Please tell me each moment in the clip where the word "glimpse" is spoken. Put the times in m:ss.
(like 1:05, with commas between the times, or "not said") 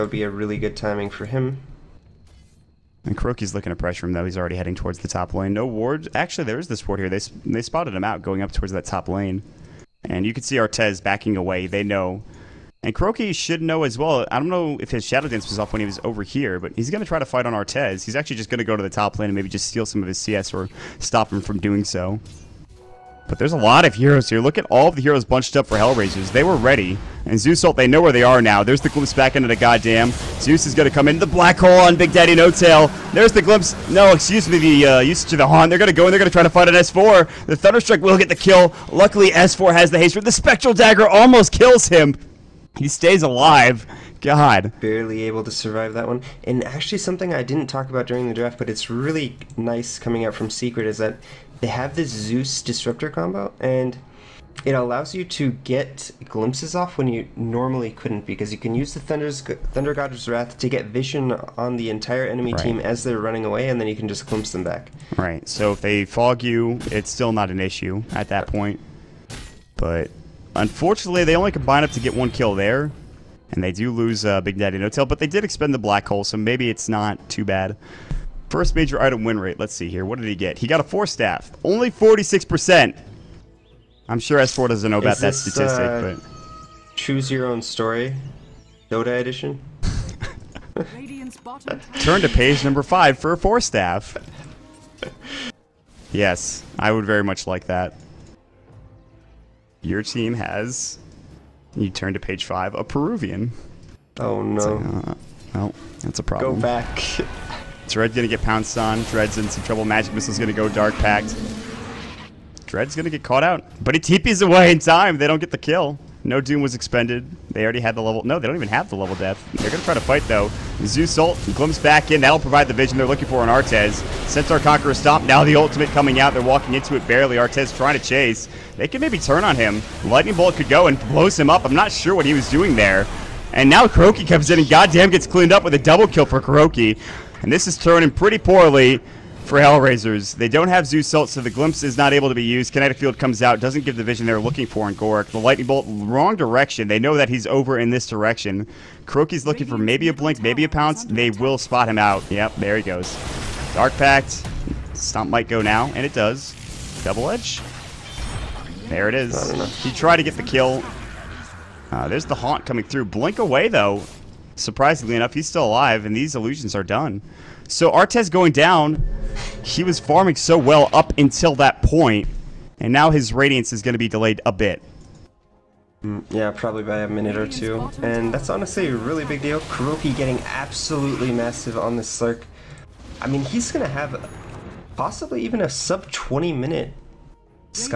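0:28, 0:33, 0:56, 1:04, 2:01, 2:21.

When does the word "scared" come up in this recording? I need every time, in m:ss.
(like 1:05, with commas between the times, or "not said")
not said.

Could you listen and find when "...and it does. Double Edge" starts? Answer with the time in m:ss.
2:35.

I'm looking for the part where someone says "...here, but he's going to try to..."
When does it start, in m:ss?
0:16.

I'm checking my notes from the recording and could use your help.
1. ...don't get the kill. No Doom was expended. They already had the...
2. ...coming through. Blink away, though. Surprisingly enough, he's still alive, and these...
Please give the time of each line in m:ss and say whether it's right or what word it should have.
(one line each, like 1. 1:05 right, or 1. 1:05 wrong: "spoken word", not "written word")
1. 1:55 right
2. 2:42 right.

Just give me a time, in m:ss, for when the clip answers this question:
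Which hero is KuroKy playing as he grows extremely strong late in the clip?
3:02.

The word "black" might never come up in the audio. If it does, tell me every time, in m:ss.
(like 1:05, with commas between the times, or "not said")
0:31, 1:15.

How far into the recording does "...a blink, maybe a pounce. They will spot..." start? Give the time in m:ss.
2:30.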